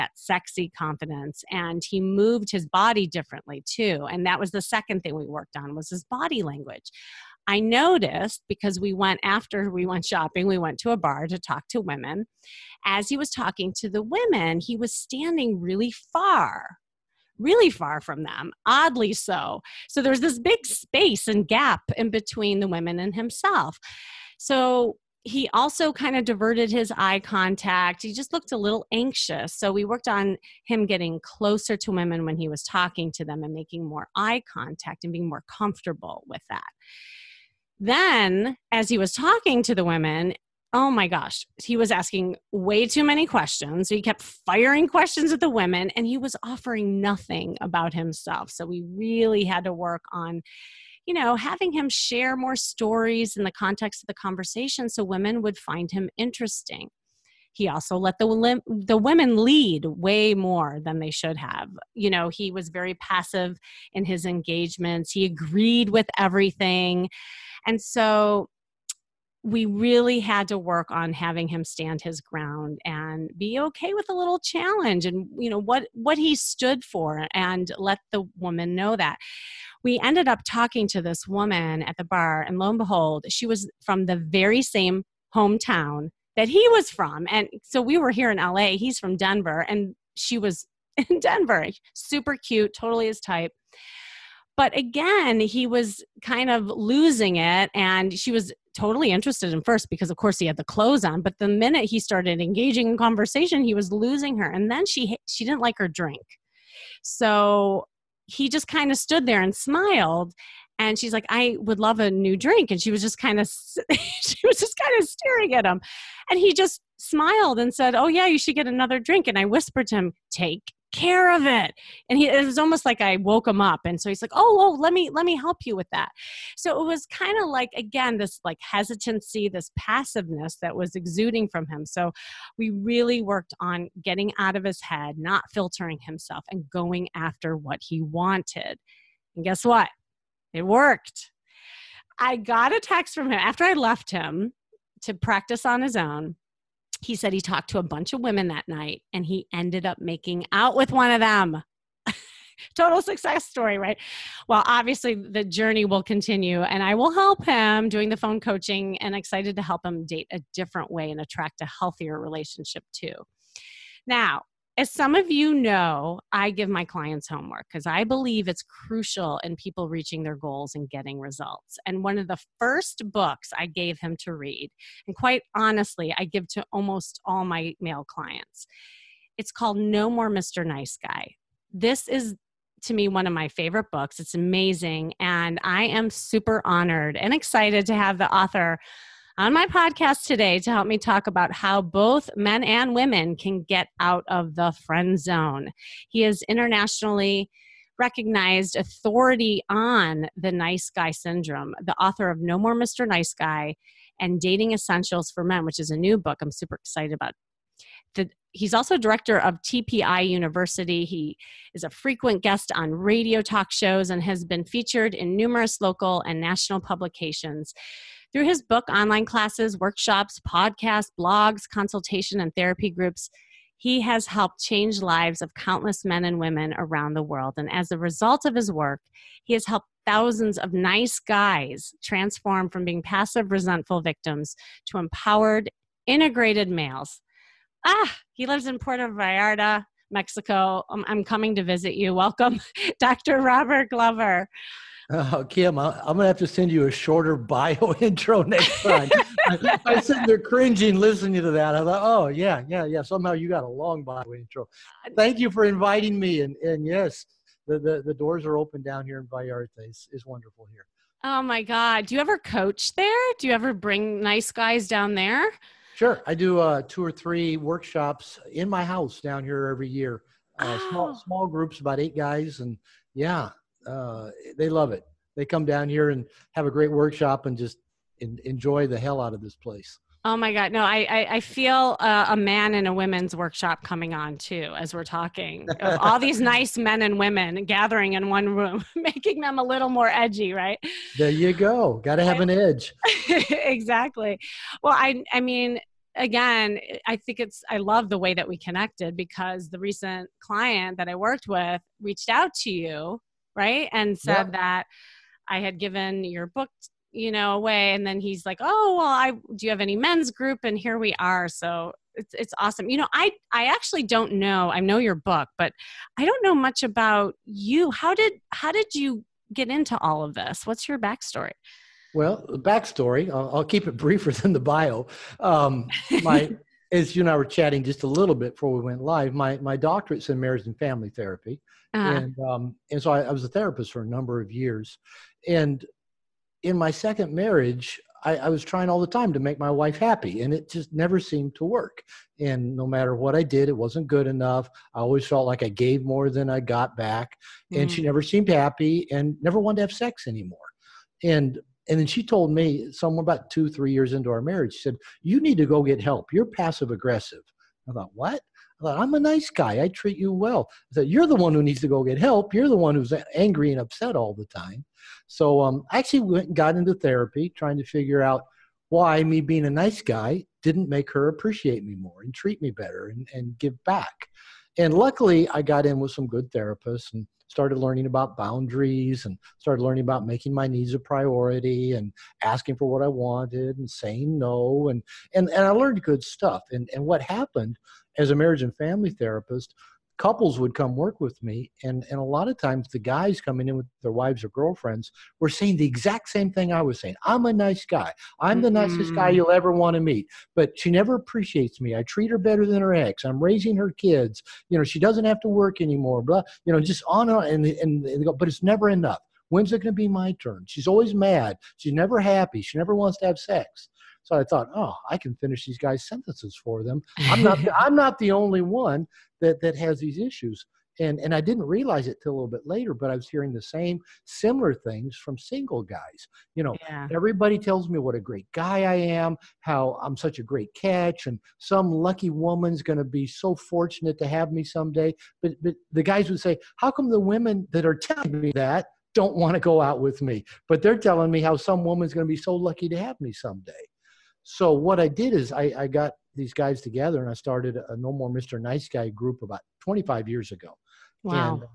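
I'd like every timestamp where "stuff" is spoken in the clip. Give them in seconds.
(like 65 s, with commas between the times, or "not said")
386 s.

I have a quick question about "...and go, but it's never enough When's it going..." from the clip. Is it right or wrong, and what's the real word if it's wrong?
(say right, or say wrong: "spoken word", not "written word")
right.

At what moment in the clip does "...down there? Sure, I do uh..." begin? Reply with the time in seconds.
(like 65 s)
264 s.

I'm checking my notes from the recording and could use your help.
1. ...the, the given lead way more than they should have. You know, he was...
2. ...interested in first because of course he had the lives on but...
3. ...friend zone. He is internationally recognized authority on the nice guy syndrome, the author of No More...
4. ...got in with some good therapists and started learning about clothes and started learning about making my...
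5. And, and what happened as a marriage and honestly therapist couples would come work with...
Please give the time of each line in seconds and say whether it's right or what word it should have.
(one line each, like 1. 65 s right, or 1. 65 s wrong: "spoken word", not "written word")
1. 58 s wrong: "women", not "given"
2. 99 s wrong: "clothes", not "lives"
3. 194 s right
4. 375 s wrong: "boundaries", not "clothes"
5. 386 s wrong: "family", not "honestly".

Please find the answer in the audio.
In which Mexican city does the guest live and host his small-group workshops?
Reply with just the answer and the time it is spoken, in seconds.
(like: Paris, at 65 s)
Puerto Vallarta, at 238 s.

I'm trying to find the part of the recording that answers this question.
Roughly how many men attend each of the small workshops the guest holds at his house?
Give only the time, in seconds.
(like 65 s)
271 s.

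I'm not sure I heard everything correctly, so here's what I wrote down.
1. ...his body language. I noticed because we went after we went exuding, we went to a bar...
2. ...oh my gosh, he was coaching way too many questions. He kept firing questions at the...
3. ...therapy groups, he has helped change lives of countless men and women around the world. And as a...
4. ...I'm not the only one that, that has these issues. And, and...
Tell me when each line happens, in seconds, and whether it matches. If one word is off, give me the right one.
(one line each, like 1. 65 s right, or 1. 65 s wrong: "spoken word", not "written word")
1. 5 s wrong: "shopping", not "exuding"
2. 40 s wrong: "asking", not "coaching"
3. 222 s right
4. 417 s right.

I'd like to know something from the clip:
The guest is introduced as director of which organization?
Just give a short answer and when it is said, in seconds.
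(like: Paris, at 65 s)
TPI University, at 209 s.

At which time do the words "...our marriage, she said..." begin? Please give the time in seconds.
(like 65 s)
354 s.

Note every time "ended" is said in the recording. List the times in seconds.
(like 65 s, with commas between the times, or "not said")
80 s, 149 s.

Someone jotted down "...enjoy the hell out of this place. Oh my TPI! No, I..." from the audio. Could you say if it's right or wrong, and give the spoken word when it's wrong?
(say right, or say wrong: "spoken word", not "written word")
wrong: "God", not "TPI".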